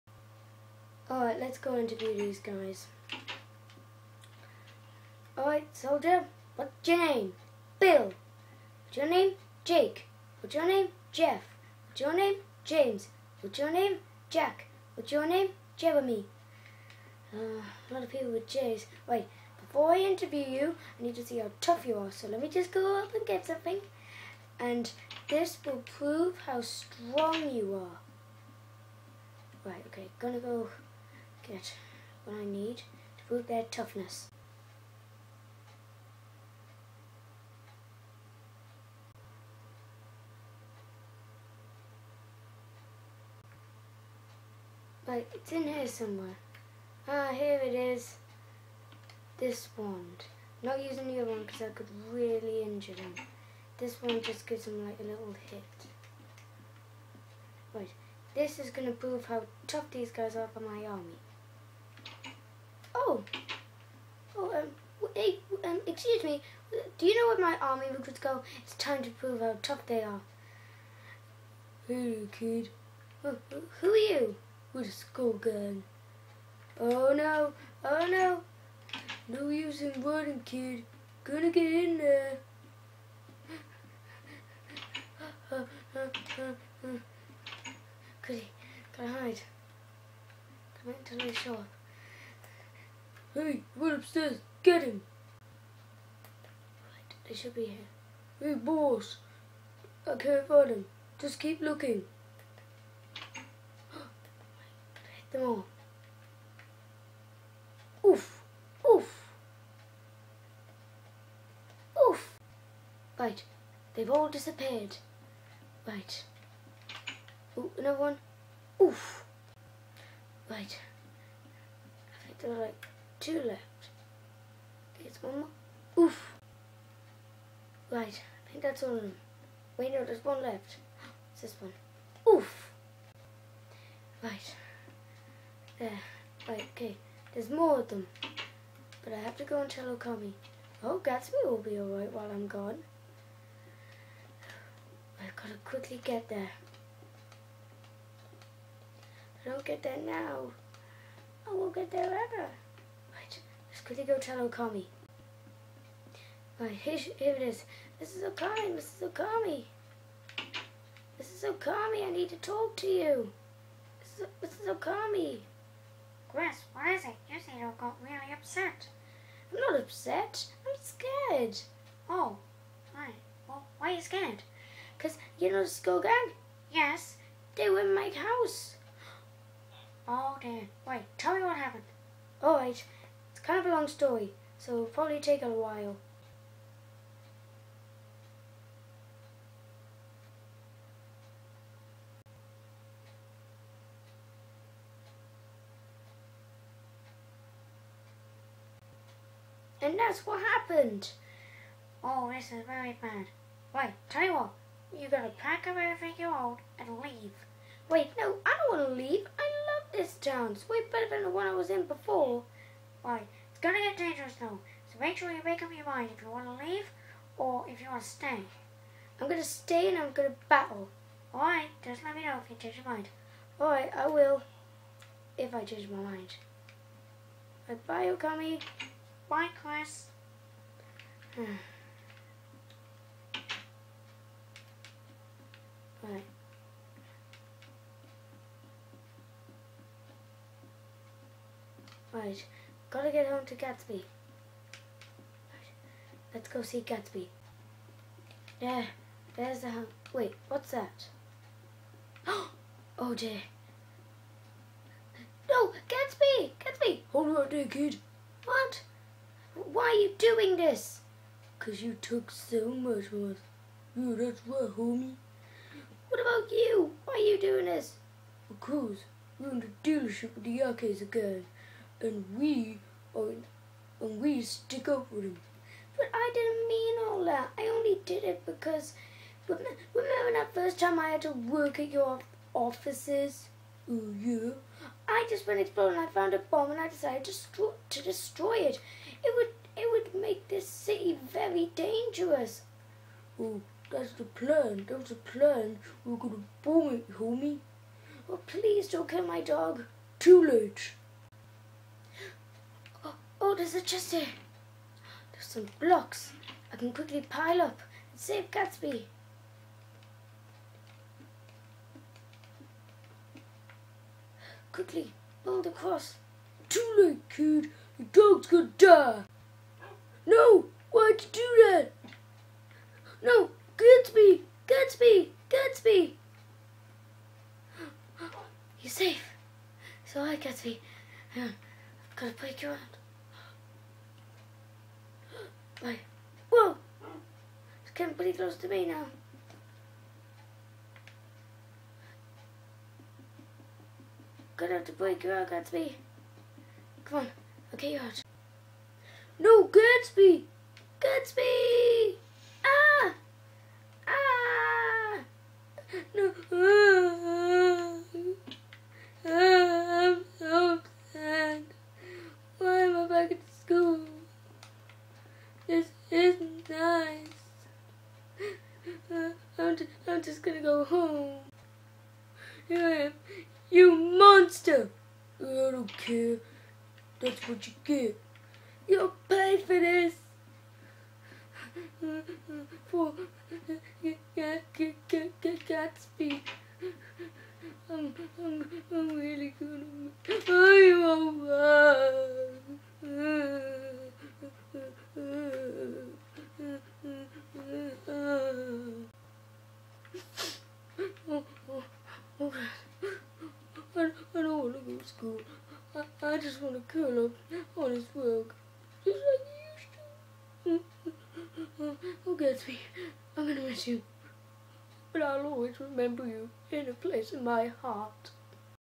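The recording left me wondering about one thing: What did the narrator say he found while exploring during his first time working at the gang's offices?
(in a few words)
A bomb.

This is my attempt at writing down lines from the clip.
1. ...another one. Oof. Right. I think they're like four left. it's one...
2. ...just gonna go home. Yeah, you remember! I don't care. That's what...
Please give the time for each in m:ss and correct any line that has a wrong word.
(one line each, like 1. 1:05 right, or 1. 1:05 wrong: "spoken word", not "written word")
1. 1:57 wrong: "two", not "four"
2. 6:10 wrong: "monster", not "remember".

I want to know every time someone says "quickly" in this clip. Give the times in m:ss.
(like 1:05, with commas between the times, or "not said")
2:25, 5:06, 5:14.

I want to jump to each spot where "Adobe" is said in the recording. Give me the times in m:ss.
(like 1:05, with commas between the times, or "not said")
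not said.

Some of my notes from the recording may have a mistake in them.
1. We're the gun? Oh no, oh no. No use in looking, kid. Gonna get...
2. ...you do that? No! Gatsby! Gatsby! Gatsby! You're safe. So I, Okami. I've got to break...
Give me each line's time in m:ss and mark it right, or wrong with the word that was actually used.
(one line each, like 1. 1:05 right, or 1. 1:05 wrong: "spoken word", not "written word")
1. 1:14 wrong: "running", not "looking"
2. 5:21 wrong: "Gatsby", not "Okami".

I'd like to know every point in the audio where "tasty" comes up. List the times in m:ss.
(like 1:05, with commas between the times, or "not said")
not said.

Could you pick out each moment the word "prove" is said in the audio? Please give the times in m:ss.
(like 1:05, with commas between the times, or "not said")
0:25, 0:33, 0:58, 1:09.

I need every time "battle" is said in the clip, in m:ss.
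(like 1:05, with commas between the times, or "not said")
3:40.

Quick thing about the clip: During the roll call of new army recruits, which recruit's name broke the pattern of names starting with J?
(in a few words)
Bill.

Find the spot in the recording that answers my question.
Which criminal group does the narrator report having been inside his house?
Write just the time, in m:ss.
2:55.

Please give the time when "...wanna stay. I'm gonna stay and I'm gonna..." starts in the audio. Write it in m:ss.
3:37.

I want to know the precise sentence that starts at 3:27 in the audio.
Wait, no, I don't wanna leave.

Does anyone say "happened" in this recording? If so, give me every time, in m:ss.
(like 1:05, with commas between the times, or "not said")
3:01, 3:20.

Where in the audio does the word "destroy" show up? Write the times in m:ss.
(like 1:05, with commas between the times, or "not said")
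4:48.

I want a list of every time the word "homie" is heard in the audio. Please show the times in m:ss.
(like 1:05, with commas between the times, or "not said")
4:24, 4:57.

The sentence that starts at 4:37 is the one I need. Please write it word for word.
I only did it because remember that first time I had to work at your offices?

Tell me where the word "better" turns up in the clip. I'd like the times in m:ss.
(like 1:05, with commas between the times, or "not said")
3:30.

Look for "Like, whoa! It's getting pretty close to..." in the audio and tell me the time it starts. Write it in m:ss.
5:35.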